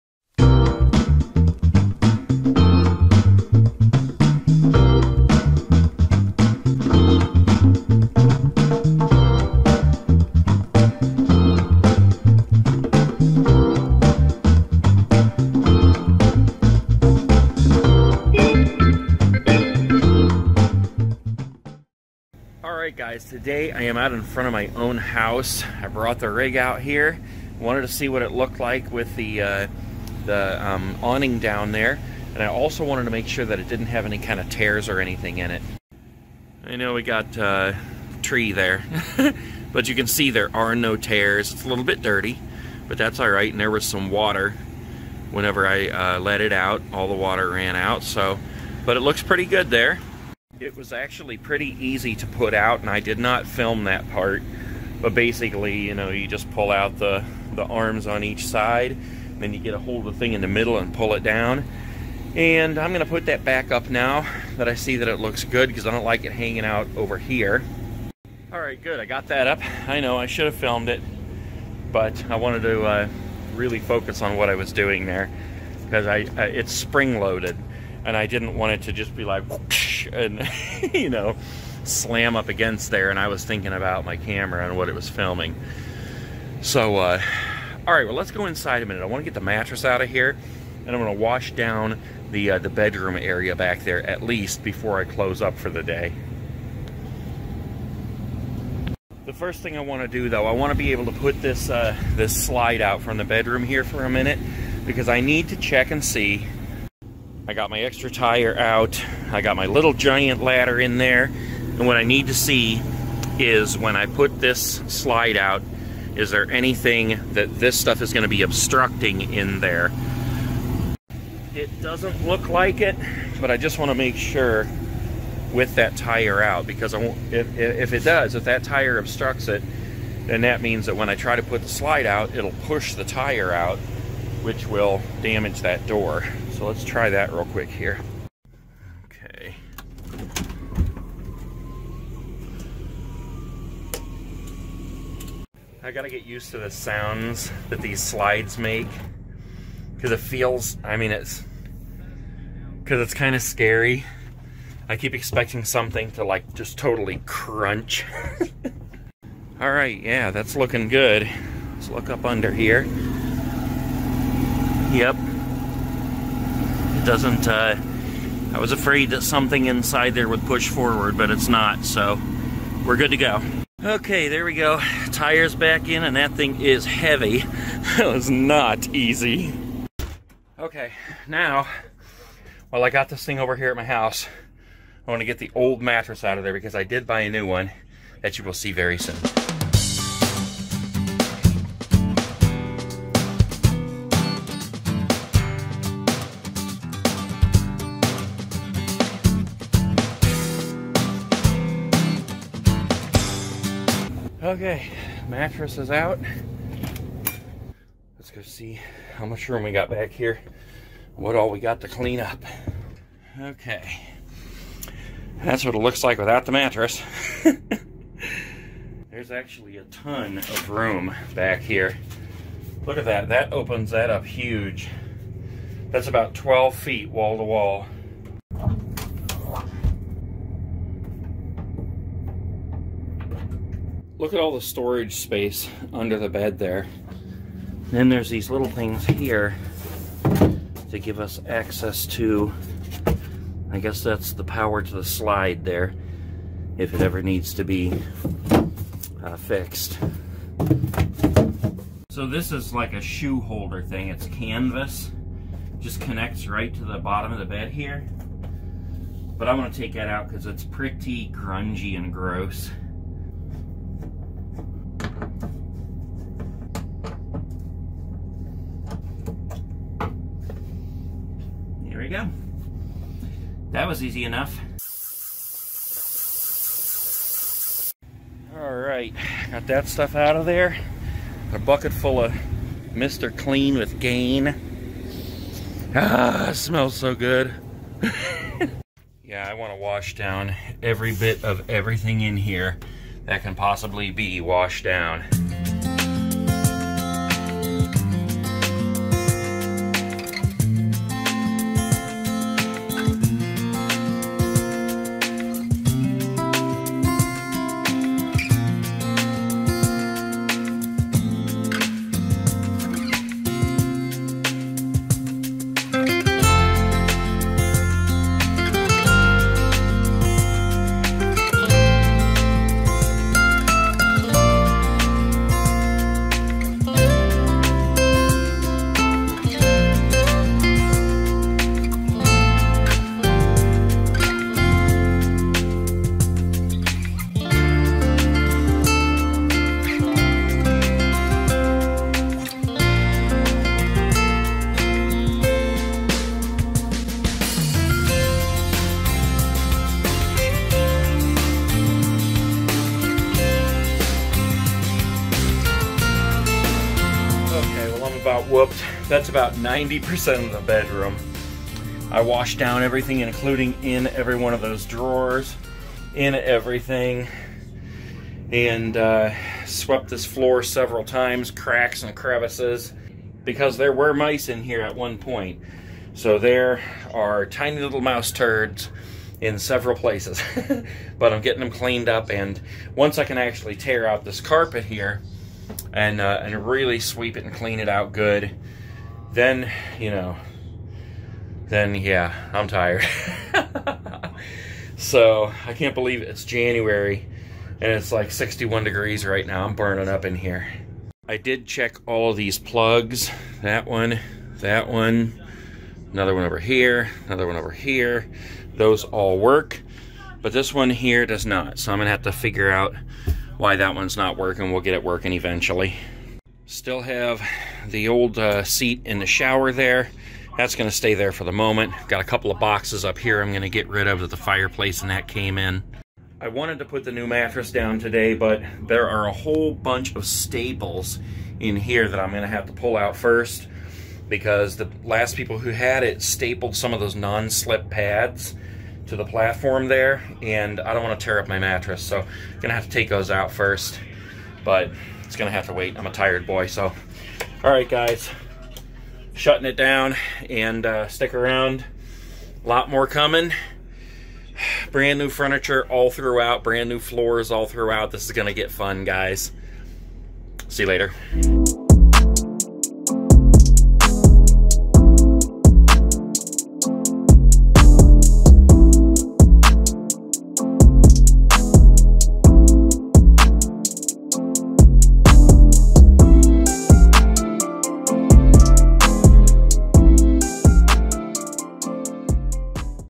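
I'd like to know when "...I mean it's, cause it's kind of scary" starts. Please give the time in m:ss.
2:30.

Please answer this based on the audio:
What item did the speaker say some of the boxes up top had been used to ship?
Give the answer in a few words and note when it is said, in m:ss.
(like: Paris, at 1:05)
fireplace, at 7:04.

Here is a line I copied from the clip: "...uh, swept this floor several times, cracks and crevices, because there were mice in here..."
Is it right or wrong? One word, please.
right.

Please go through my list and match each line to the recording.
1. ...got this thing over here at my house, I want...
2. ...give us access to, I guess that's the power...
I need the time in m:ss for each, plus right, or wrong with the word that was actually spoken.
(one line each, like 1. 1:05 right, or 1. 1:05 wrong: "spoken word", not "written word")
1. 3:02 right
2. 4:00 right.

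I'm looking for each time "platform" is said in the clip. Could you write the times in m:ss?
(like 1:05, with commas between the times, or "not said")
7:19.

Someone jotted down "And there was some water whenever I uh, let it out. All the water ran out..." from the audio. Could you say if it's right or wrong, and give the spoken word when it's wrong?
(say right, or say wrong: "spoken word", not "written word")
right.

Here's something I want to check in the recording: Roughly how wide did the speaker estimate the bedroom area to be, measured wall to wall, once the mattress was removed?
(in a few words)
12 feet.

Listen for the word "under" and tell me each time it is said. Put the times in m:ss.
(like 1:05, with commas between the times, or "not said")
2:42, 3:55.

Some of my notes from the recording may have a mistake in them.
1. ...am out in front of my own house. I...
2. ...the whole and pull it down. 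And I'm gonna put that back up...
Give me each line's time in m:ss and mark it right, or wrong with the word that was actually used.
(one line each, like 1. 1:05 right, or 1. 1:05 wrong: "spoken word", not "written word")
1. 0:23 right
2. 1:00 wrong: "middle", not "whole".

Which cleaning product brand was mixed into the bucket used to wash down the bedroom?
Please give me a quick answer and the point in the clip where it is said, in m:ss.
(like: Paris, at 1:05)
Mr. Clean with Gain, at 4:42.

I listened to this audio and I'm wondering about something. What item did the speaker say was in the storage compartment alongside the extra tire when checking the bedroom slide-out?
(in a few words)
little giant ladder.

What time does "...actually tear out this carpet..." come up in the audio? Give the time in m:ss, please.
6:23.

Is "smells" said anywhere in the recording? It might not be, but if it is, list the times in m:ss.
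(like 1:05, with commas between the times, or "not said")
4:46.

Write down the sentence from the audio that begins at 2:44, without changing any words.
Yep, doesn't, uh, I was afraid that something inside there would push forward, but it's not, so we're good to go.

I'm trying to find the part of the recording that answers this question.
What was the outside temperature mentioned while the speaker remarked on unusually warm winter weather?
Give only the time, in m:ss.
6:38.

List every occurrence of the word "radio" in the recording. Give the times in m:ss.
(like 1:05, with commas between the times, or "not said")
not said.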